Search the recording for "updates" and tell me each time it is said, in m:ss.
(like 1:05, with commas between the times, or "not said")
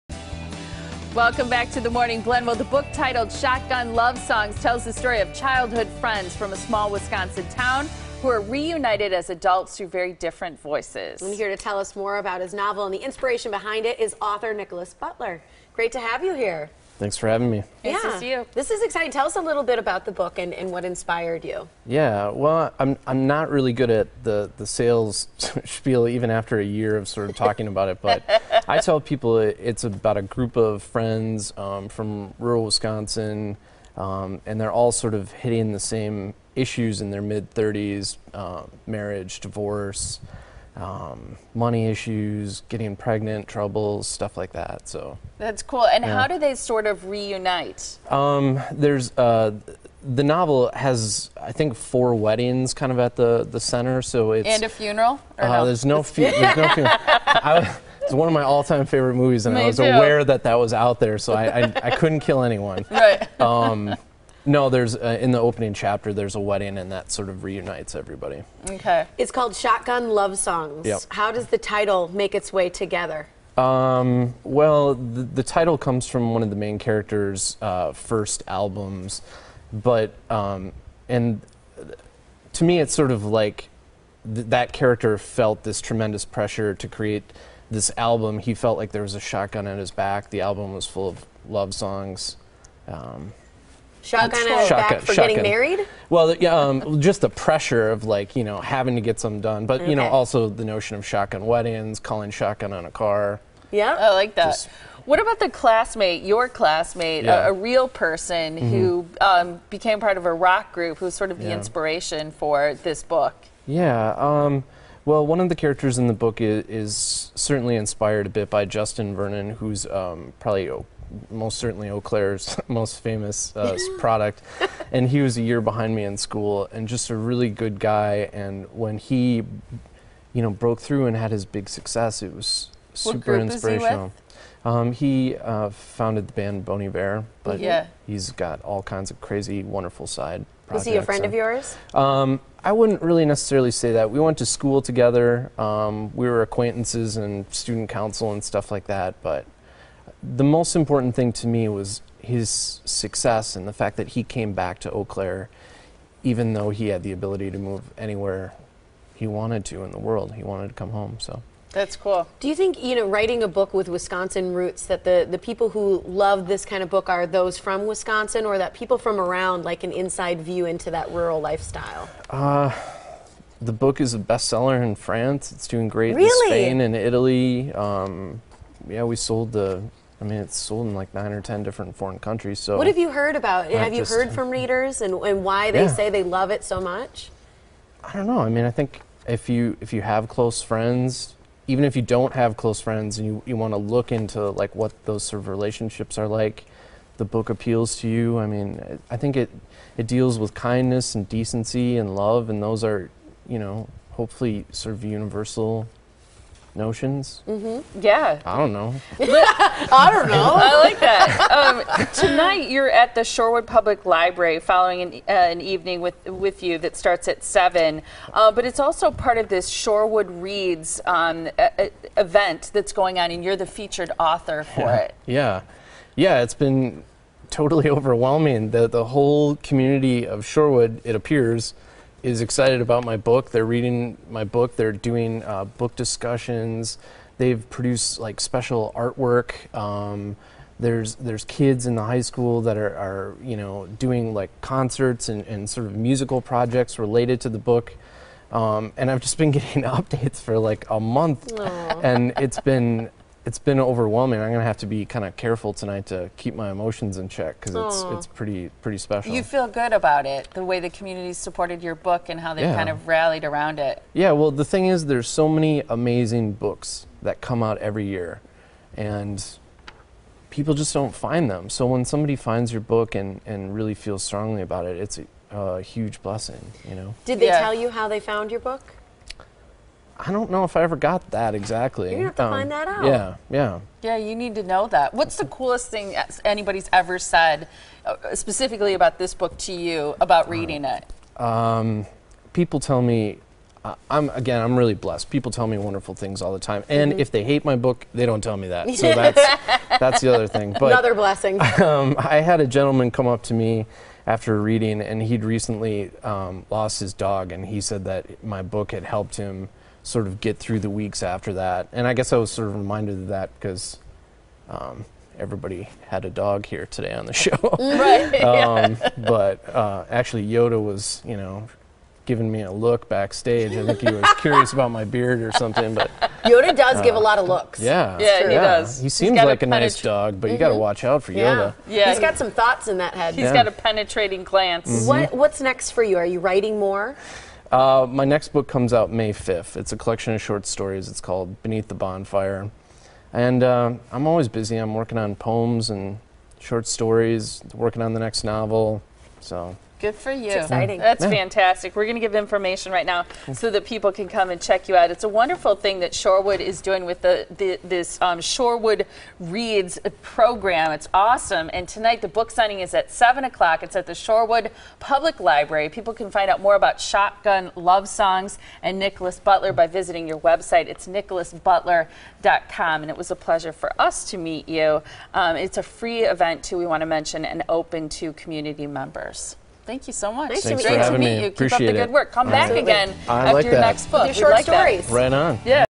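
4:09.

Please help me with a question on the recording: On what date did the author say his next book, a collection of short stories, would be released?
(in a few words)
May 5.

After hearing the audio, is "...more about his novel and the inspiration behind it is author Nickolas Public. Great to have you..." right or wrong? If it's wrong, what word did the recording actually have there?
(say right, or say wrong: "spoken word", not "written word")
wrong: "Butler", not "Public".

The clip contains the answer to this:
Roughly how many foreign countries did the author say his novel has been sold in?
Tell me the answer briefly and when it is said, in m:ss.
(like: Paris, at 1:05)
9 or 10, at 3:01.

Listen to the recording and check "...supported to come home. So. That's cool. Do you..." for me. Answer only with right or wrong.
wrong.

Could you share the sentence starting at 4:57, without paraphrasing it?
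if they hate my book, they don't tell me that.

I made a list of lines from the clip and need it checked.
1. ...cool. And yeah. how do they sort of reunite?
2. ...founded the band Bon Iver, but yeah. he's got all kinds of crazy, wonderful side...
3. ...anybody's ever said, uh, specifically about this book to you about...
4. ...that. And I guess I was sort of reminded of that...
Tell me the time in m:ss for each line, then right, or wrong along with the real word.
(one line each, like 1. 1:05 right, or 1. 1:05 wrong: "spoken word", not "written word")
1. 0:45 right
2. 2:15 right
3. 4:46 right
4. 5:11 right.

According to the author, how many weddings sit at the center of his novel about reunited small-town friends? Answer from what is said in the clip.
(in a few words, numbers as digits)
4.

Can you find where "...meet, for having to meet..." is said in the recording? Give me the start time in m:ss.
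6:20.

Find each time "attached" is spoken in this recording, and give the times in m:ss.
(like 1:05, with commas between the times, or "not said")
not said.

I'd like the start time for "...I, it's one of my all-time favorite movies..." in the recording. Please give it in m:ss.
0:57.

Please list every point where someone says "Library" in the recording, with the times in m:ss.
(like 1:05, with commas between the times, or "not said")
3:34, 6:05.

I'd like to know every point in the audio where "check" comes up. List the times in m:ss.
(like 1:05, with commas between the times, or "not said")
4:17, 5:54.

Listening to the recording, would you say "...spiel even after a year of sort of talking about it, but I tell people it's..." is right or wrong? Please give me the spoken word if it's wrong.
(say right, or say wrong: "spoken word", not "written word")
right.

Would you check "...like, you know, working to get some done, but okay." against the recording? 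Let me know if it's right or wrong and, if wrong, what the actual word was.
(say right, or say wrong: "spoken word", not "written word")
wrong: "having", not "working".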